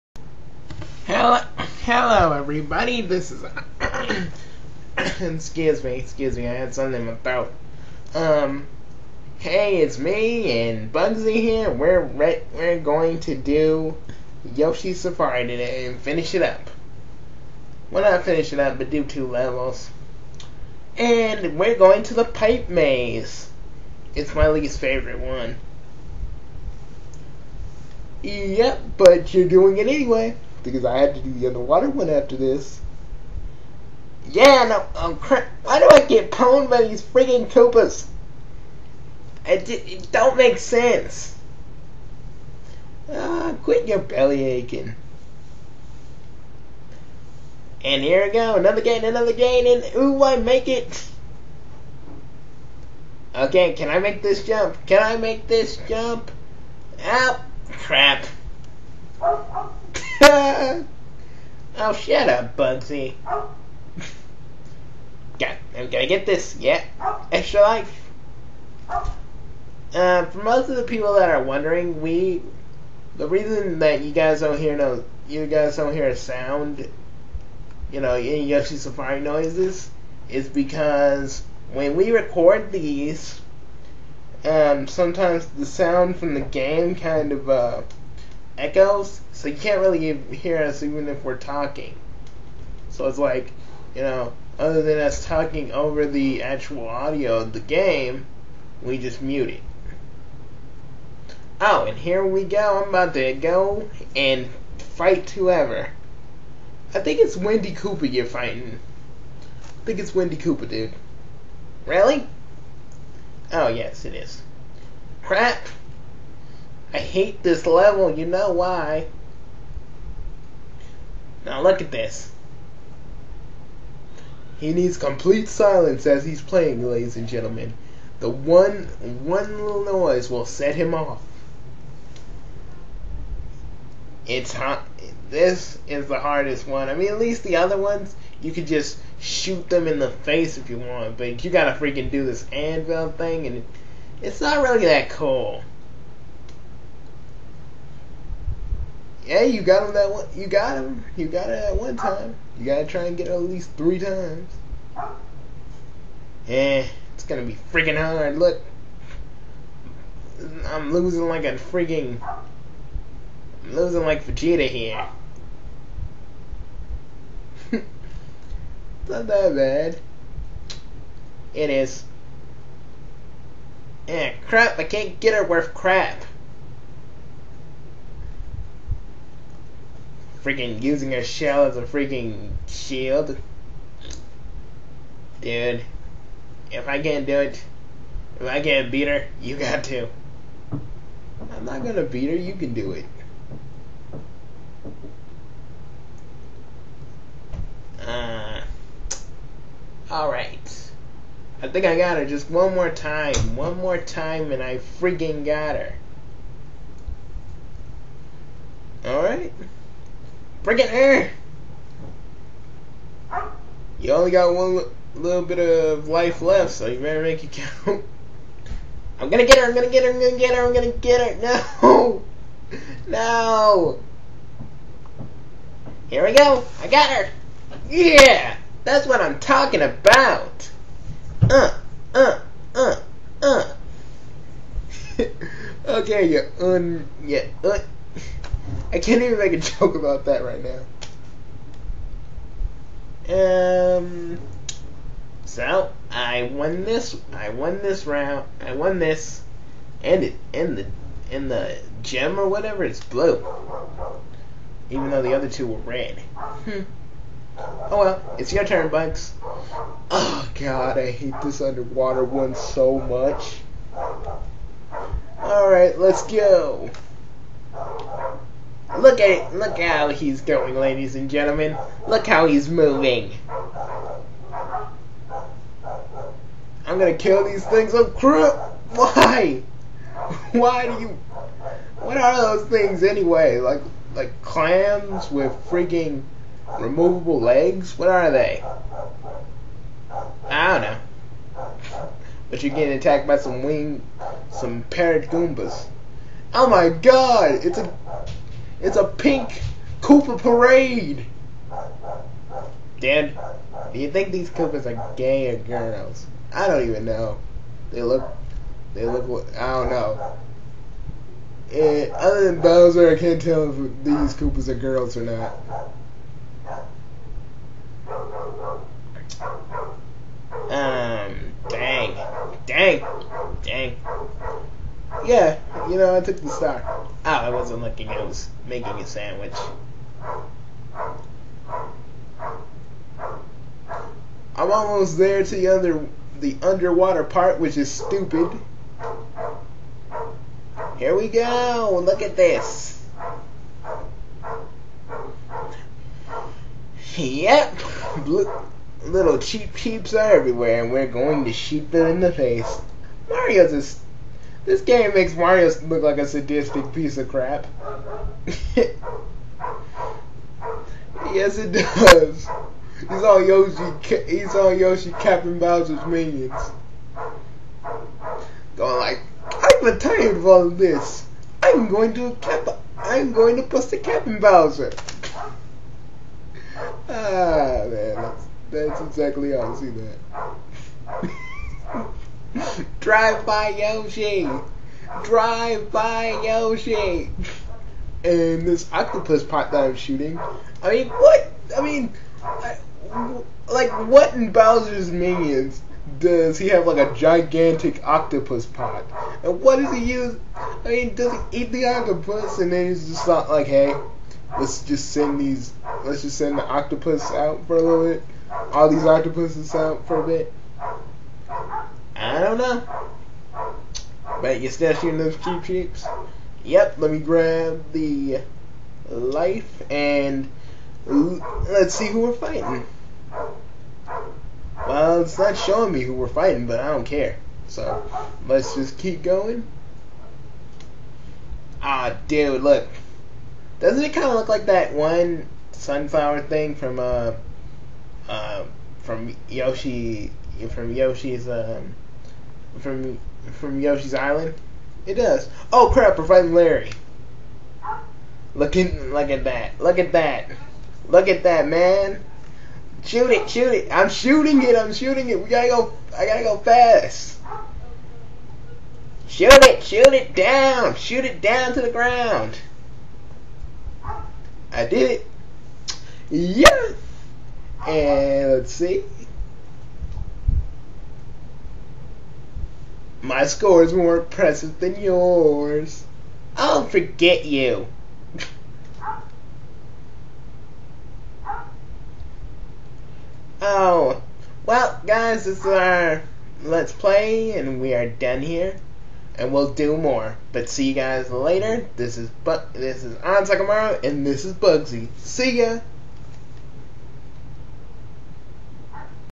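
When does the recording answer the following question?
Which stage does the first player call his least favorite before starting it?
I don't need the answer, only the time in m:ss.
0:22.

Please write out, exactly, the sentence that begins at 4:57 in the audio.
It's a it's a pink Koopa parade.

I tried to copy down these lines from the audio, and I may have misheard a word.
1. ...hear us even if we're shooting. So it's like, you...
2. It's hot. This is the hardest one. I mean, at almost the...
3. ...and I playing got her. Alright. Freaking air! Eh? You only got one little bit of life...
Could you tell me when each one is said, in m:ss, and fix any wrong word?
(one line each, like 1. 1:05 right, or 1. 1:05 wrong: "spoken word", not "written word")
1. 1:30 wrong: "talking", not "shooting"
2. 2:14 wrong: "least", not "almost"
3. 3:24 wrong: "freaking", not "playing".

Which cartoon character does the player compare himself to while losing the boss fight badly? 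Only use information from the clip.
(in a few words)
Vegeta.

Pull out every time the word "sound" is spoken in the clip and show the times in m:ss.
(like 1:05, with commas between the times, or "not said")
1:16, 1:25.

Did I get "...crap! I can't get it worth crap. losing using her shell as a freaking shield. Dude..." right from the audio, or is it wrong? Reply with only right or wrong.
wrong.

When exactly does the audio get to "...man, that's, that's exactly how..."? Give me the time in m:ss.
6:17.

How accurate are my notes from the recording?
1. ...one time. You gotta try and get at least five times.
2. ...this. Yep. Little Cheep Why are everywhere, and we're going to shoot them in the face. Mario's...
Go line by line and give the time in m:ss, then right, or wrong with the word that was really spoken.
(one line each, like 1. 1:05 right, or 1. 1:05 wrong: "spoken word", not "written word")
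1. 2:31 wrong: "three", not "five"
2. 5:42 wrong: "Cheeps", not "Why".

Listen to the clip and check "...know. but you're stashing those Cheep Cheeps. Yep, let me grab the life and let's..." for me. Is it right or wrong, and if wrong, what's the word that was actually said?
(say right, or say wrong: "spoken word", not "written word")
right.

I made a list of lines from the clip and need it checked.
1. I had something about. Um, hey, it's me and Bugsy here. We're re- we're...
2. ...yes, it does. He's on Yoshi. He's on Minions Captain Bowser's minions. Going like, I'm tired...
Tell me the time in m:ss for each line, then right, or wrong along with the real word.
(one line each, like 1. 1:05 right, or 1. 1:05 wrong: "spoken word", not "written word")
1. 0:06 right
2. 6:01 wrong: "Yoshi", not "Minions".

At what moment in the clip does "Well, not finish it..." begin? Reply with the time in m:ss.
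0:17.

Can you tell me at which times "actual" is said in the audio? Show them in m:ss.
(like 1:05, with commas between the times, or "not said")
1:36.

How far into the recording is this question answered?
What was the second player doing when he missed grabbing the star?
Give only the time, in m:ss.
5:28.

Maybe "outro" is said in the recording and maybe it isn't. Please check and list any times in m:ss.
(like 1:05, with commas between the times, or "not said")
not said.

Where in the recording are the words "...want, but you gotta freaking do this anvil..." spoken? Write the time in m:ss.
2:20.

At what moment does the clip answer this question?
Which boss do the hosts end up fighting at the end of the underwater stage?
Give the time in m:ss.
7:26.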